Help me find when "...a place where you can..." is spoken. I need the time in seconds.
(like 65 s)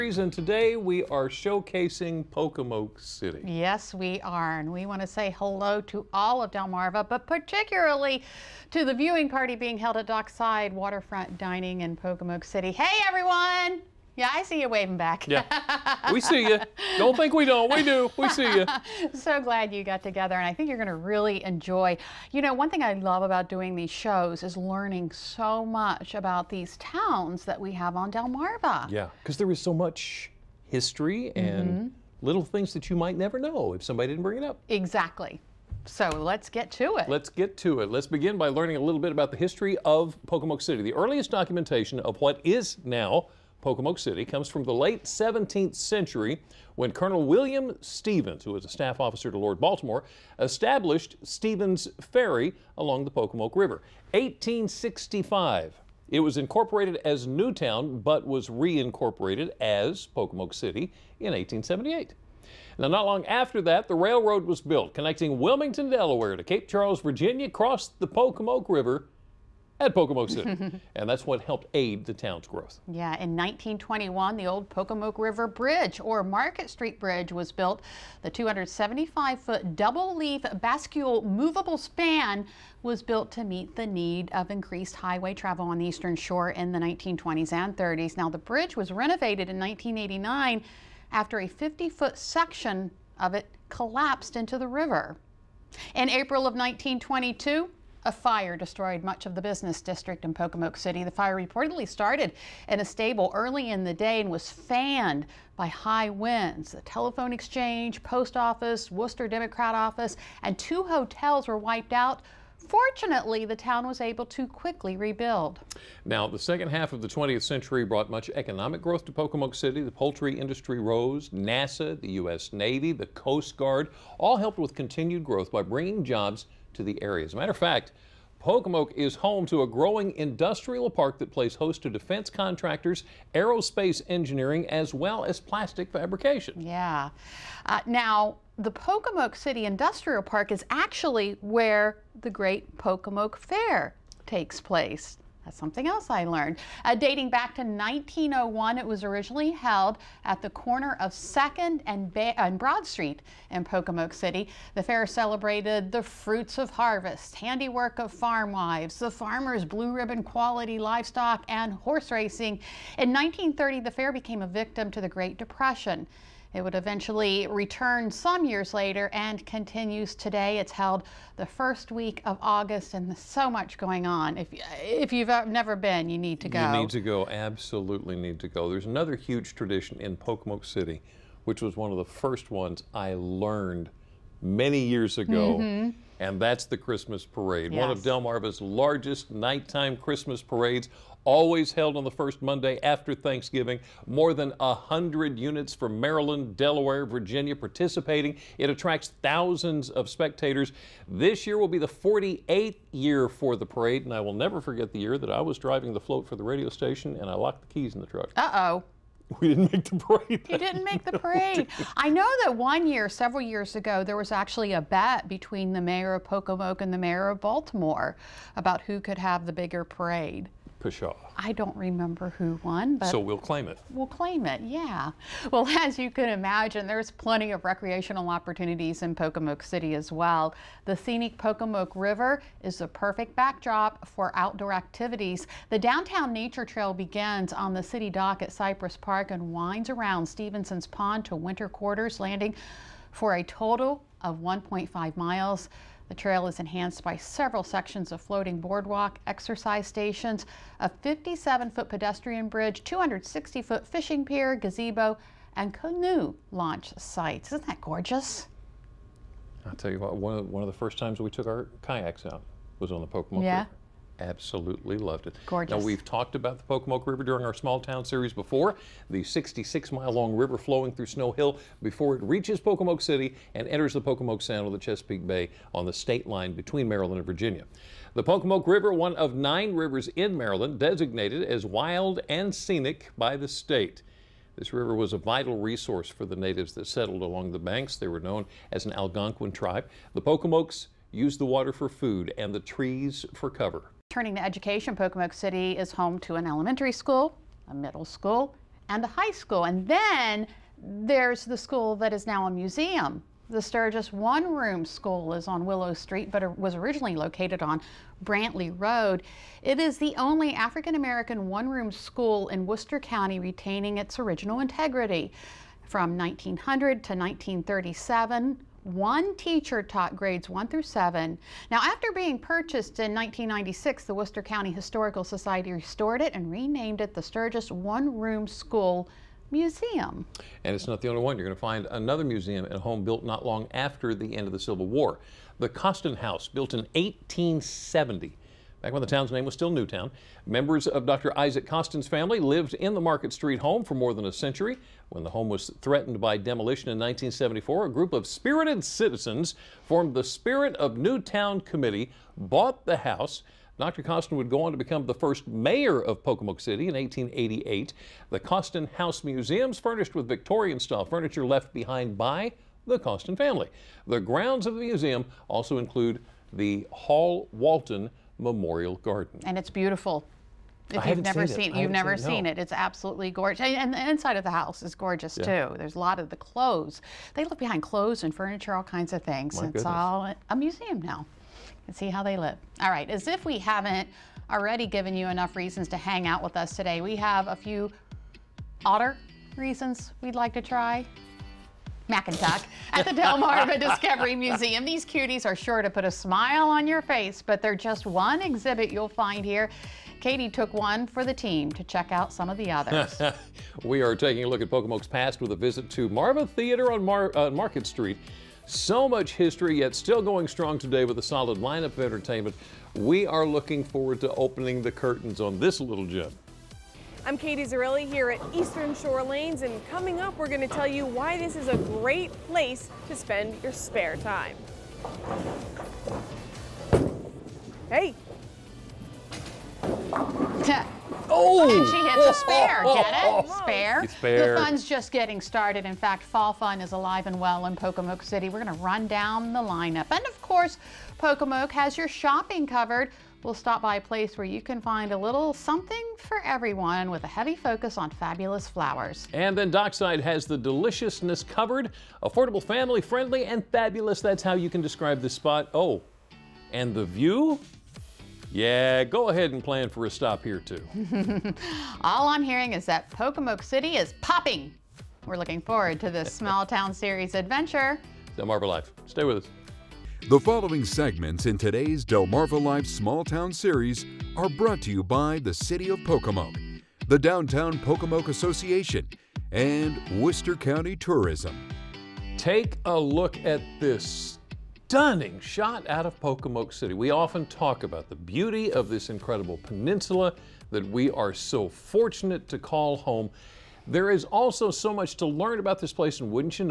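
443 s.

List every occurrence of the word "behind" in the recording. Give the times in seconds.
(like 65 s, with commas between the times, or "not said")
361 s, 377 s.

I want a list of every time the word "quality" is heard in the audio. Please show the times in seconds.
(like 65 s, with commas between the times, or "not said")
160 s.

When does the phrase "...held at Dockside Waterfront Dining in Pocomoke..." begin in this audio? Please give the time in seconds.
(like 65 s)
9 s.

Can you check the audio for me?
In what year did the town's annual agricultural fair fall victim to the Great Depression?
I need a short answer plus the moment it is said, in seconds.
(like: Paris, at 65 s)
1930, at 163 s.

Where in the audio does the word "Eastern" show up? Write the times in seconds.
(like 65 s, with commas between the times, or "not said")
85 s, 418 s.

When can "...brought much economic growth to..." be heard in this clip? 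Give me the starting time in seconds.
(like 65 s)
117 s.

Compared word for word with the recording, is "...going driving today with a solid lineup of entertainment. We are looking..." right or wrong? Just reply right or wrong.
wrong.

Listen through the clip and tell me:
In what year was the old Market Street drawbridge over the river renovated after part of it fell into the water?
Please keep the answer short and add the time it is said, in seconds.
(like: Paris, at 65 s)
1989, at 89 s.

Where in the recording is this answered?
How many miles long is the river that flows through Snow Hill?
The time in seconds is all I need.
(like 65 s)
269 s.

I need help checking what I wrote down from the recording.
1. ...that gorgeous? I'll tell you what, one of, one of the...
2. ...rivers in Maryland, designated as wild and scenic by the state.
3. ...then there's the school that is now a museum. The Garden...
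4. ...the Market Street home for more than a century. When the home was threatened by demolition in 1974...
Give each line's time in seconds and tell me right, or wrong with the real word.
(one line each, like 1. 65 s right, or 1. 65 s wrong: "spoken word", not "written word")
1. 257 s right
2. 279 s right
3. 299 s wrong: "Sturgis", not "Garden"
4. 342 s right.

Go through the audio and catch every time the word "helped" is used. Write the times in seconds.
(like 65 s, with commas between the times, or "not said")
71 s, 124 s.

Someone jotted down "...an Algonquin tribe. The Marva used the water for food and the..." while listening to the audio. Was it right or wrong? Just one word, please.
wrong.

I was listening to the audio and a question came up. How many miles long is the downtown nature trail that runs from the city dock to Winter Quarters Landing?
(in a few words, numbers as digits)
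1.5.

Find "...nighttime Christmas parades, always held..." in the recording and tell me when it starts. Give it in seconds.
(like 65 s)
189 s.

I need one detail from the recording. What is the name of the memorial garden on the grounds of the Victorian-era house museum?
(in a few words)
Hall Walton Memorial Garden.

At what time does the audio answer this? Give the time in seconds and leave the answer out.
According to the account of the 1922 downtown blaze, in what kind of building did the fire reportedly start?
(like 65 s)
102 s.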